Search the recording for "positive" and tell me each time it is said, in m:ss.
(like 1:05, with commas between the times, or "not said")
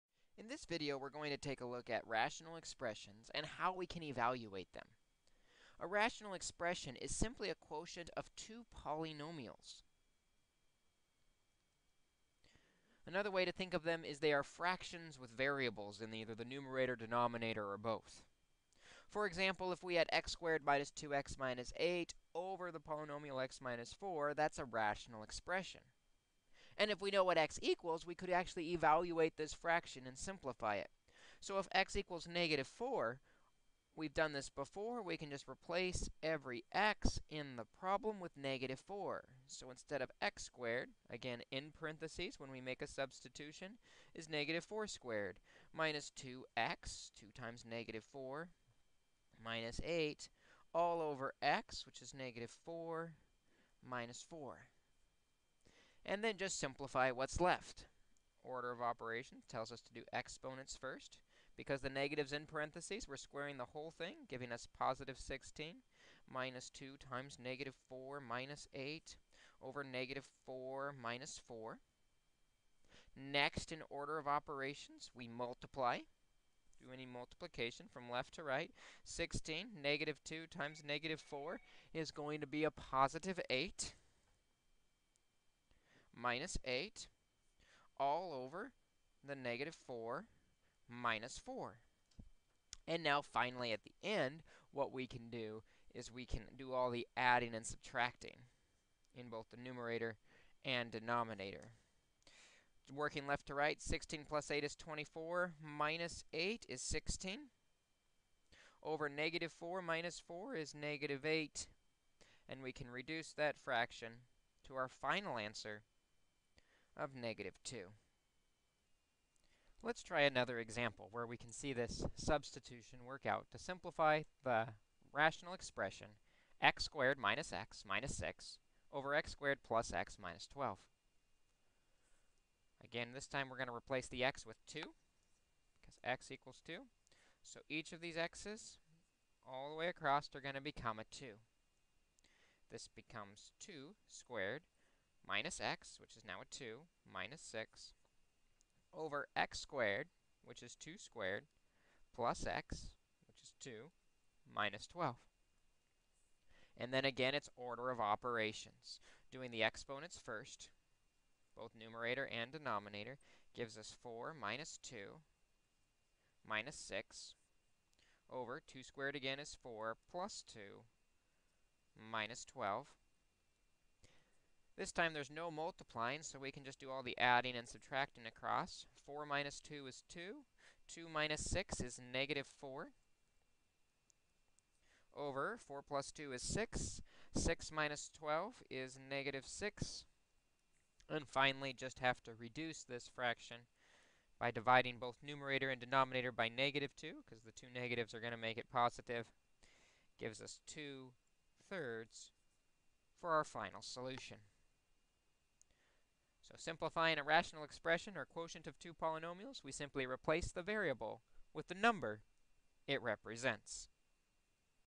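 1:04, 1:22, 3:18.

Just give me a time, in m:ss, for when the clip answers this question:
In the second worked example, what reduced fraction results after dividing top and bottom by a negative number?
3:20.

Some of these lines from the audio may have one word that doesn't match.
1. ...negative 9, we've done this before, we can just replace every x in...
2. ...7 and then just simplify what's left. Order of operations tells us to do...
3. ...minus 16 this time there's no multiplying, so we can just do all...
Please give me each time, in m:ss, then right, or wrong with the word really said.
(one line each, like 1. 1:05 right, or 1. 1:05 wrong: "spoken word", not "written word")
1. 0:32 wrong: "4", not "9"
2. 0:54 wrong: "4", not "7"
3. 2:52 wrong: "12", not "16".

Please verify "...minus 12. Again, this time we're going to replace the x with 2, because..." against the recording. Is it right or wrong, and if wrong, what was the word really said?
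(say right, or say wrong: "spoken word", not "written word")
right.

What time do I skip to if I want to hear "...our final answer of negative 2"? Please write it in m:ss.
1:54.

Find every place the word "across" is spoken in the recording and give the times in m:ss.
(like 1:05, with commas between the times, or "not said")
2:19, 2:58.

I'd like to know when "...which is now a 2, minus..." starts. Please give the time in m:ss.
2:26.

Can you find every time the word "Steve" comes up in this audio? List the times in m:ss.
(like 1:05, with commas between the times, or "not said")
not said.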